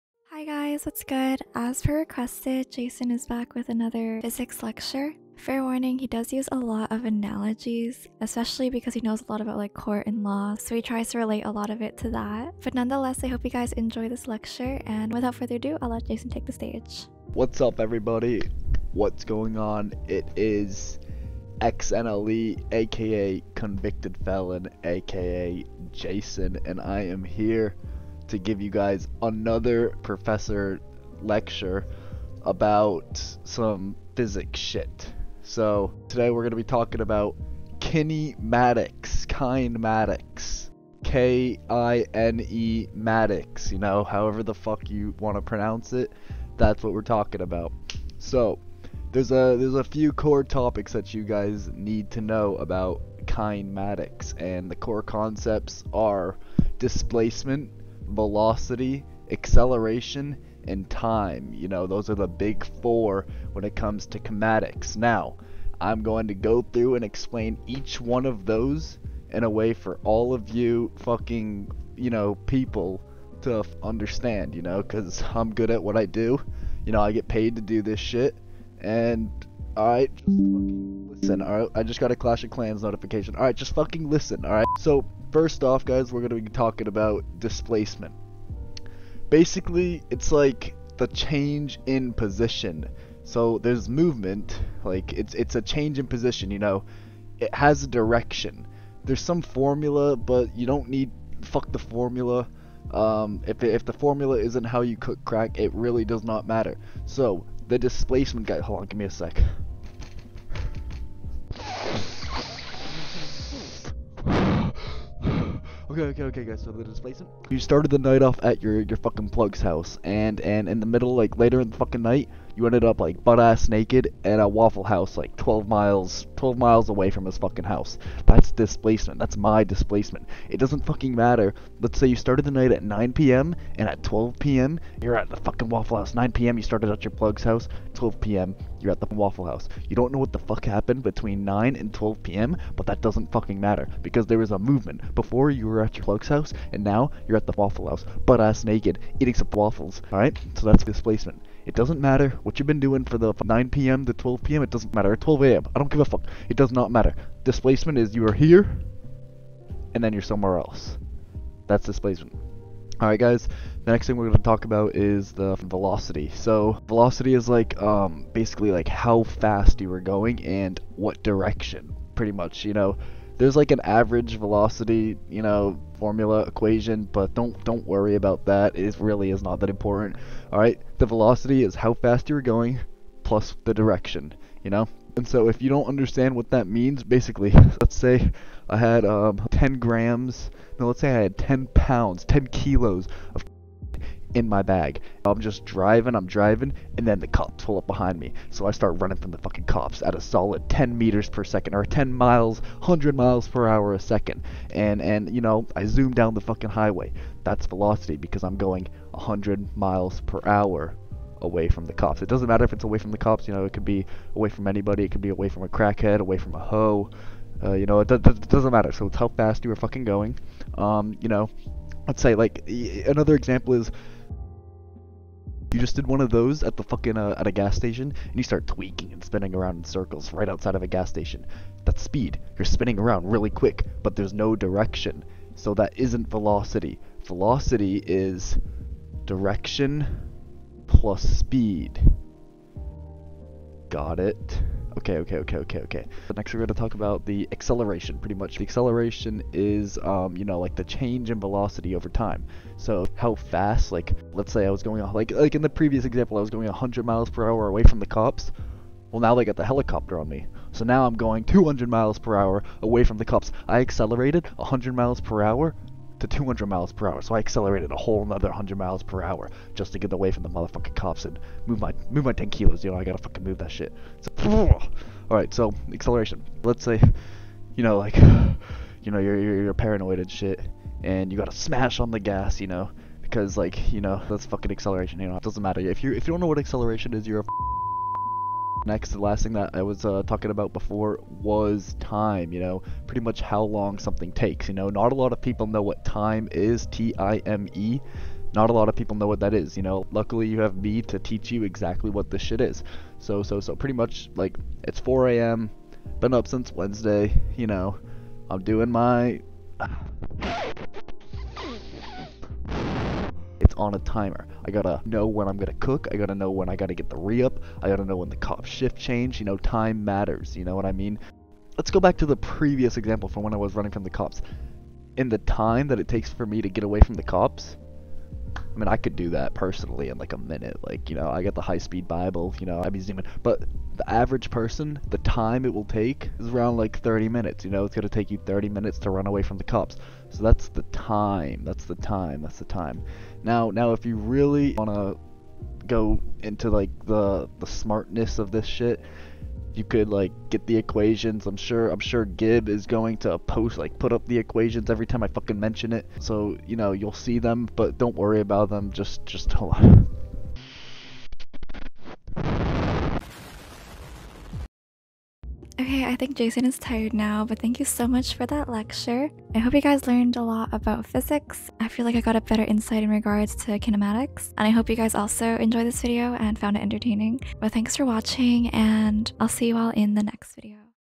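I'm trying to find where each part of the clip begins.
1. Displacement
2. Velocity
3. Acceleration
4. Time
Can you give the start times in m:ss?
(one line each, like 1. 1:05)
1. 1:20
2. 2:43
3. 4:06
4. 4:50.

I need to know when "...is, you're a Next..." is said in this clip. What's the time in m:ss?
4:47.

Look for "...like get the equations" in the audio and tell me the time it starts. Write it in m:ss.
5:50.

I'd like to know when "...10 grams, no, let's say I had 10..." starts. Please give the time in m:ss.
3:09.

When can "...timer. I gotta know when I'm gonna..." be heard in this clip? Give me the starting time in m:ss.
5:13.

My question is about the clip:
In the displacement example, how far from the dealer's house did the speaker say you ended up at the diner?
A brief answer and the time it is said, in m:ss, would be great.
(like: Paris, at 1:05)
12 miles, at 2:06.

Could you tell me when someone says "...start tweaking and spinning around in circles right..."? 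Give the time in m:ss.
3:48.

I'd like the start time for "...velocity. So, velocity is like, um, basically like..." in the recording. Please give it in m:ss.
2:45.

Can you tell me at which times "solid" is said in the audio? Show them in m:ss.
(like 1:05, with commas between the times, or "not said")
3:20.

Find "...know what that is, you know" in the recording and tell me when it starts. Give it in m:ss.
4:59.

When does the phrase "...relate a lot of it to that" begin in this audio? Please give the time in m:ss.
0:11.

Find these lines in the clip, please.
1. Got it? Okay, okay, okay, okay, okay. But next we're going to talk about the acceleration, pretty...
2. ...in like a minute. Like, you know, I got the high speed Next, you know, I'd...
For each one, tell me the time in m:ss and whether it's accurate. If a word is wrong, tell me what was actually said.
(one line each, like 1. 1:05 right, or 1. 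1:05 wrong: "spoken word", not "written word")
1. 4:03 right
2. 5:30 wrong: "Bible", not "Next".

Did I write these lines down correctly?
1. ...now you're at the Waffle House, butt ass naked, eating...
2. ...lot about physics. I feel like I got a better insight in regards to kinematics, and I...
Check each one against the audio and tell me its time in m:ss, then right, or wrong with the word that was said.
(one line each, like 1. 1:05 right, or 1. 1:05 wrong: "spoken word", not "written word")
1. 2:26 right
2. 6:10 right.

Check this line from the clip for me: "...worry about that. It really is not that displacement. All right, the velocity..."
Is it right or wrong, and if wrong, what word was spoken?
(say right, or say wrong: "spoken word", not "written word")
wrong: "important", not "displacement".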